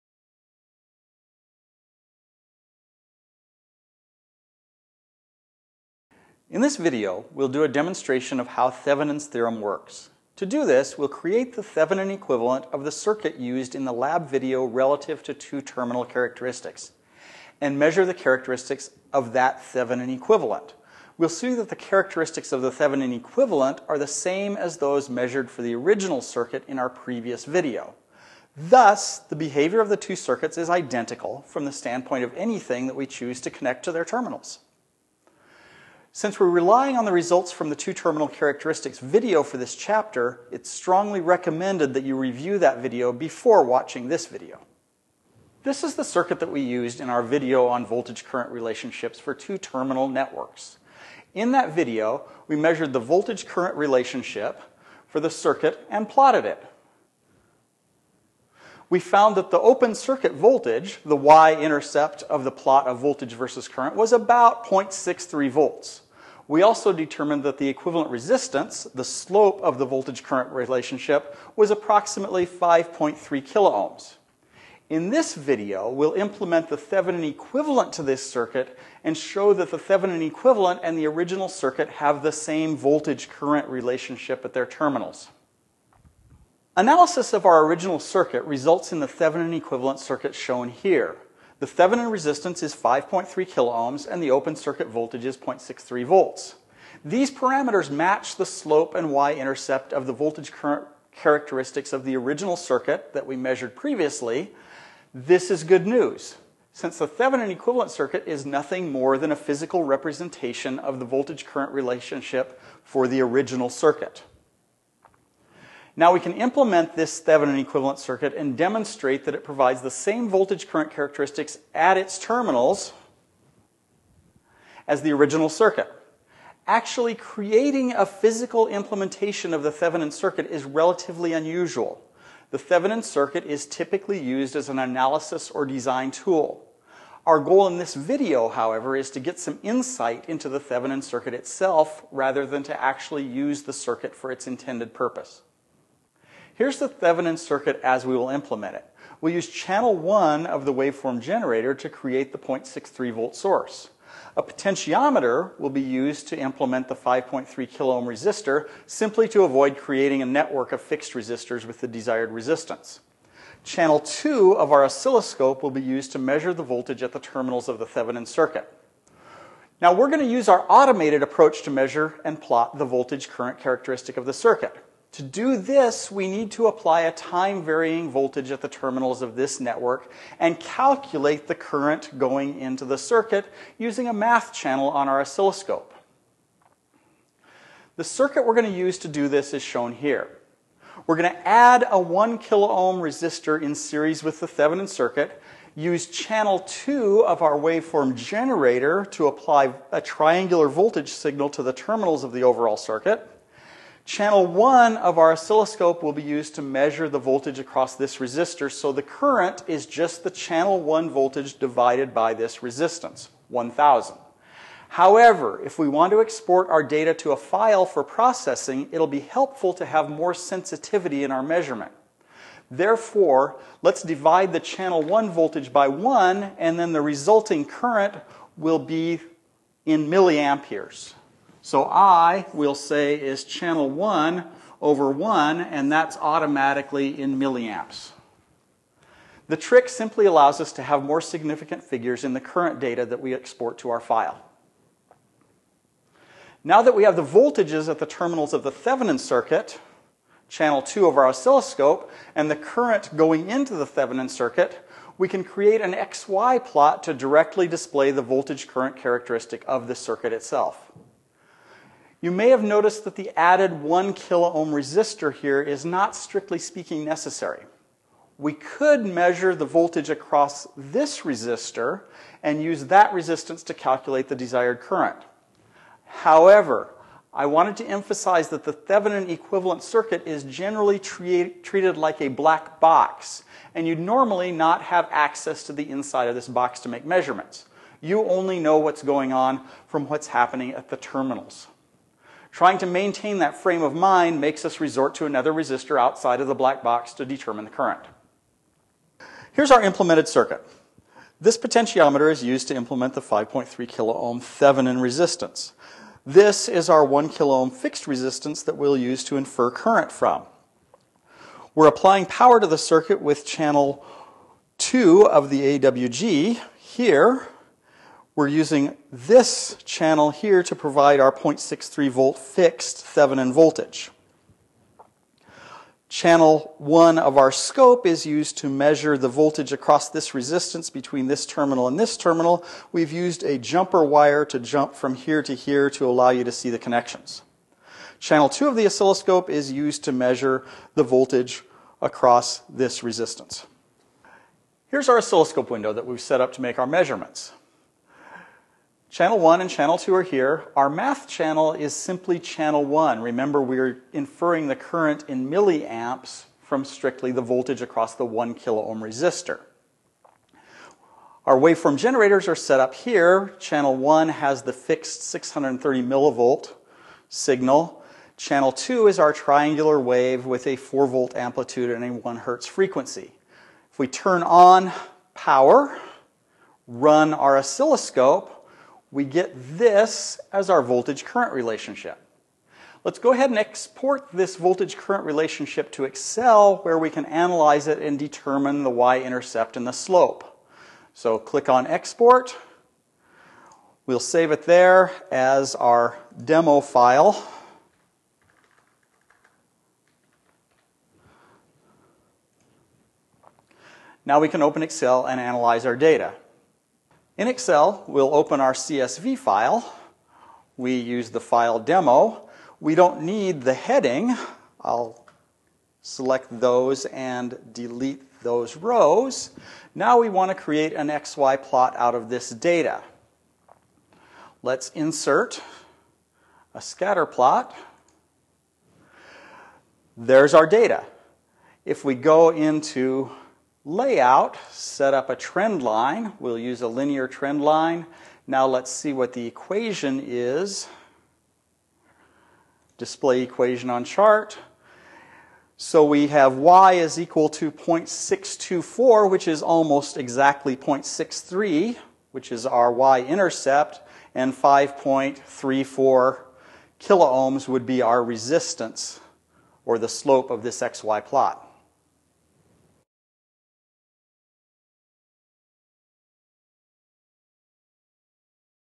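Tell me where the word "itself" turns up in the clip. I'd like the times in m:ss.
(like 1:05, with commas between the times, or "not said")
2:21, 4:20.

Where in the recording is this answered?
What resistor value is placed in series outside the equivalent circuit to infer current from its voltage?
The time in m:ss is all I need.
3:11.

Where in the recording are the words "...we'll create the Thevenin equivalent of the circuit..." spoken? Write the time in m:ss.
0:10.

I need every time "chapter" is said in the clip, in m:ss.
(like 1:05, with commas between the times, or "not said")
0:39.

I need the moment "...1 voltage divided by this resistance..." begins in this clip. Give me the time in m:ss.
3:30.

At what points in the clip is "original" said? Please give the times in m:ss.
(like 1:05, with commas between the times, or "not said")
0:25, 1:21, 1:27, 1:42, 1:53, 2:05.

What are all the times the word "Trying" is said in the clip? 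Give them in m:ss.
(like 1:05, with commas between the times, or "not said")
4:52.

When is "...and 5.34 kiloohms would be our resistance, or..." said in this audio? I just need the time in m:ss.
7:34.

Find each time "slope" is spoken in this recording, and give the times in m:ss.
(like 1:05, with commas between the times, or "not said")
1:09, 1:38, 6:29, 7:40.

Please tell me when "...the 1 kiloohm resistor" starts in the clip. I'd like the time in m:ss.
5:58.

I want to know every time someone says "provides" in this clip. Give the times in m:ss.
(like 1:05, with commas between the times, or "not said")
1:59, 5:20.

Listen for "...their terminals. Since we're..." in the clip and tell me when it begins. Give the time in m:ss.
0:33.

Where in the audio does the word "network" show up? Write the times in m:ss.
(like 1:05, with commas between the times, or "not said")
0:50, 2:40, 2:59.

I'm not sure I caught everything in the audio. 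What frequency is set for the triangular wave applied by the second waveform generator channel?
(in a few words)
1 hertz.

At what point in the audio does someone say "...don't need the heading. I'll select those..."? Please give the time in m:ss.
6:52.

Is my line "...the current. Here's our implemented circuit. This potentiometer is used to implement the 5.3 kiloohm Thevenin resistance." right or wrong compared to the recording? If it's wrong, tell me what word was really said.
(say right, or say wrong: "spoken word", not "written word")
right.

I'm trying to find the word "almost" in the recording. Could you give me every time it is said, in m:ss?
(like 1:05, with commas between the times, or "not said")
7:29.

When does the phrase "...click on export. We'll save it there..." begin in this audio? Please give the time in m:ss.
6:31.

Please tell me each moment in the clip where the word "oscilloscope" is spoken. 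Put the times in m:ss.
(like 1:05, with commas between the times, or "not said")
2:44, 3:05, 3:25, 4:11, 5:38, 5:45, 6:17.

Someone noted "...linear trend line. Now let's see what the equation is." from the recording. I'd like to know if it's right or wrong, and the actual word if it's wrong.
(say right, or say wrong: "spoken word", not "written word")
right.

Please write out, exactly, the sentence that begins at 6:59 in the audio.
Now we want to create an XY plot out of this data.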